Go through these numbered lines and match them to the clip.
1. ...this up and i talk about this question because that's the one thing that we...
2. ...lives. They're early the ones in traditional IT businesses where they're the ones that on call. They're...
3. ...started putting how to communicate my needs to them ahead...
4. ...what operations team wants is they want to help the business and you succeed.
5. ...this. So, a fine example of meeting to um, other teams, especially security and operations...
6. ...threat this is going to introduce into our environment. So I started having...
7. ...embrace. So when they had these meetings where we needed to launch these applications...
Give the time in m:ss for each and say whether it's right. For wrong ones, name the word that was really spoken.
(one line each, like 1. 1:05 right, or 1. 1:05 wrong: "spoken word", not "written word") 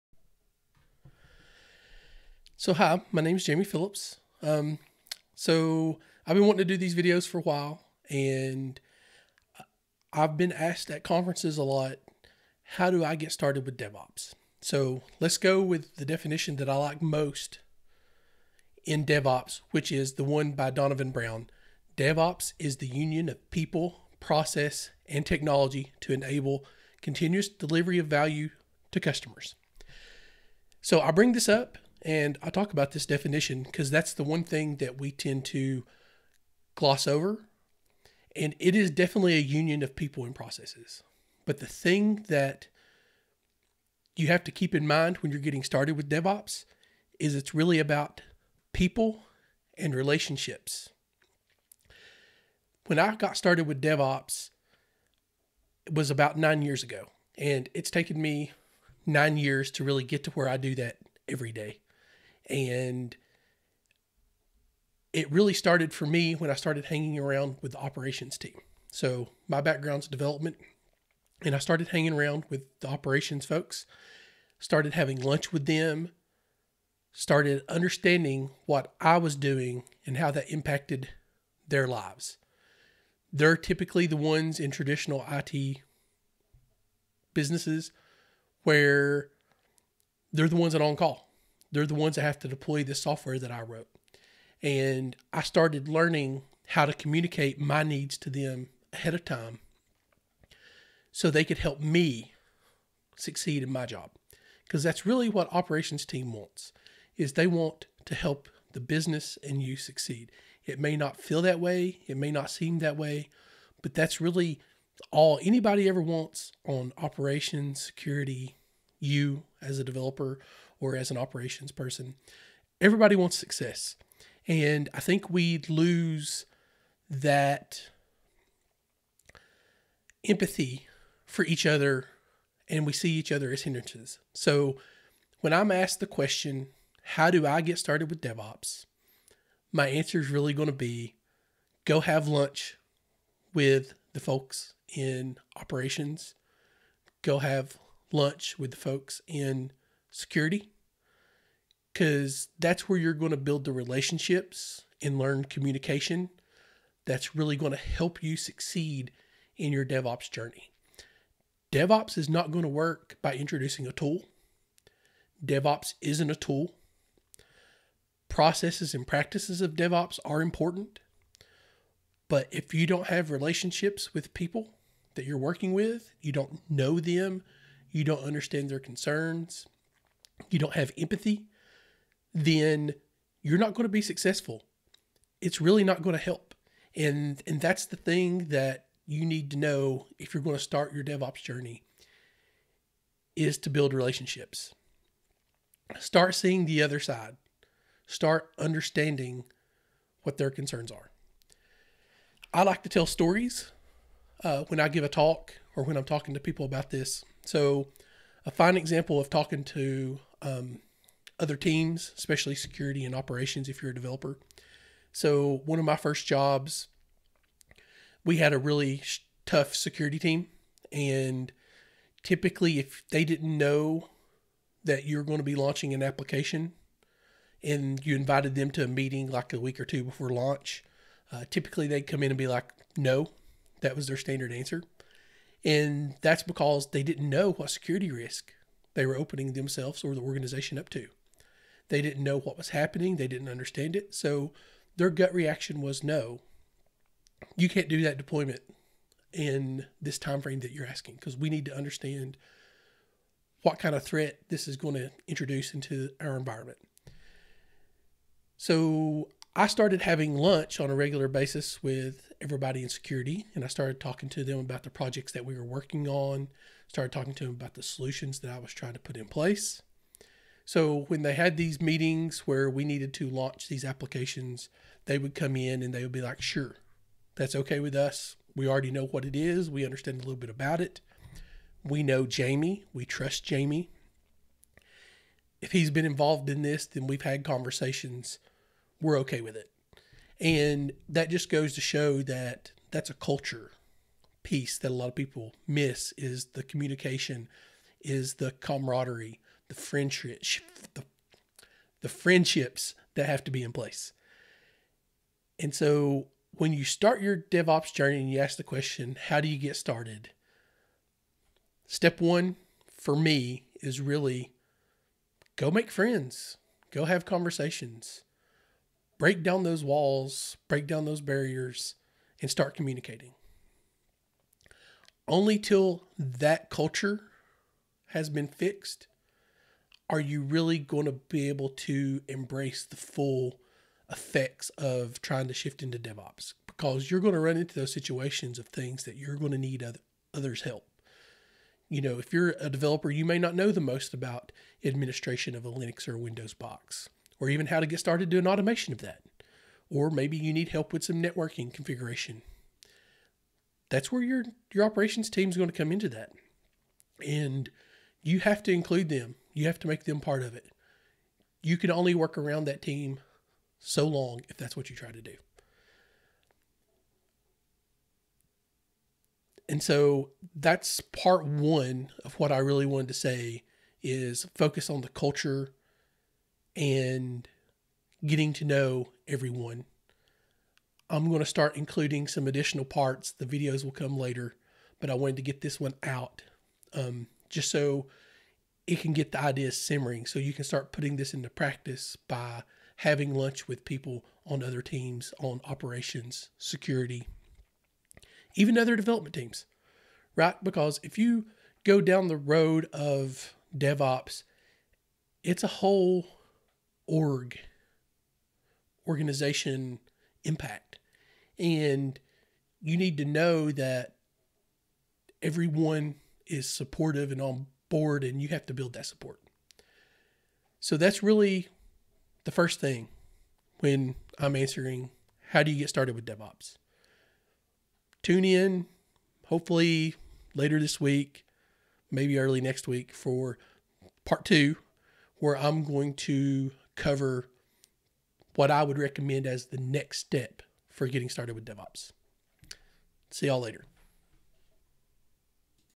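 1. 0:31 wrong: "definition", not "question"
2. 1:21 wrong: "typically", not "early"
3. 1:35 wrong: "learning", not "putting"
4. 1:45 right
5. 3:26 wrong: "talking", not "meeting"
6. 4:14 right
7. 4:29 wrong: "place", not "embrace".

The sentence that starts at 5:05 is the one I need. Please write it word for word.
And so when you start your DevOps journey and you ask the question, how do you get started?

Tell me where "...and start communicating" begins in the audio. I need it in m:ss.
5:22.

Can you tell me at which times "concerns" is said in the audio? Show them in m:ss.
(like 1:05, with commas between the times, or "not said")
2:58, 3:20.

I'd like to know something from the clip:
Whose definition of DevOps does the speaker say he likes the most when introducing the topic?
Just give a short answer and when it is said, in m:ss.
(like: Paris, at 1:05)
Donovan Brown, at 0:20.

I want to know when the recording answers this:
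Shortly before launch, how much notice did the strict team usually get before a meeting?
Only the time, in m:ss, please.
3:49.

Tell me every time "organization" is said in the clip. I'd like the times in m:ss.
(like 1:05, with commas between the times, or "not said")
4:00, 6:49.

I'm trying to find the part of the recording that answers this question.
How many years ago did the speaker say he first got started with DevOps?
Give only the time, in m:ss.
0:56.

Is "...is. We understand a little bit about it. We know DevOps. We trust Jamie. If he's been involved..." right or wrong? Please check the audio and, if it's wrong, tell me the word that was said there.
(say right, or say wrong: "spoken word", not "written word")
wrong: "Jamie", not "DevOps".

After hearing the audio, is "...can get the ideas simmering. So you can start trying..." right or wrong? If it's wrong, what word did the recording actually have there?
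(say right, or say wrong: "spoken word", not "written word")
wrong: "putting", not "trying".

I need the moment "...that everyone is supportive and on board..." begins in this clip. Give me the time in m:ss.
6:53.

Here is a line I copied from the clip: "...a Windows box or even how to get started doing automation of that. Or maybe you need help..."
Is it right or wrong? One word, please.
right.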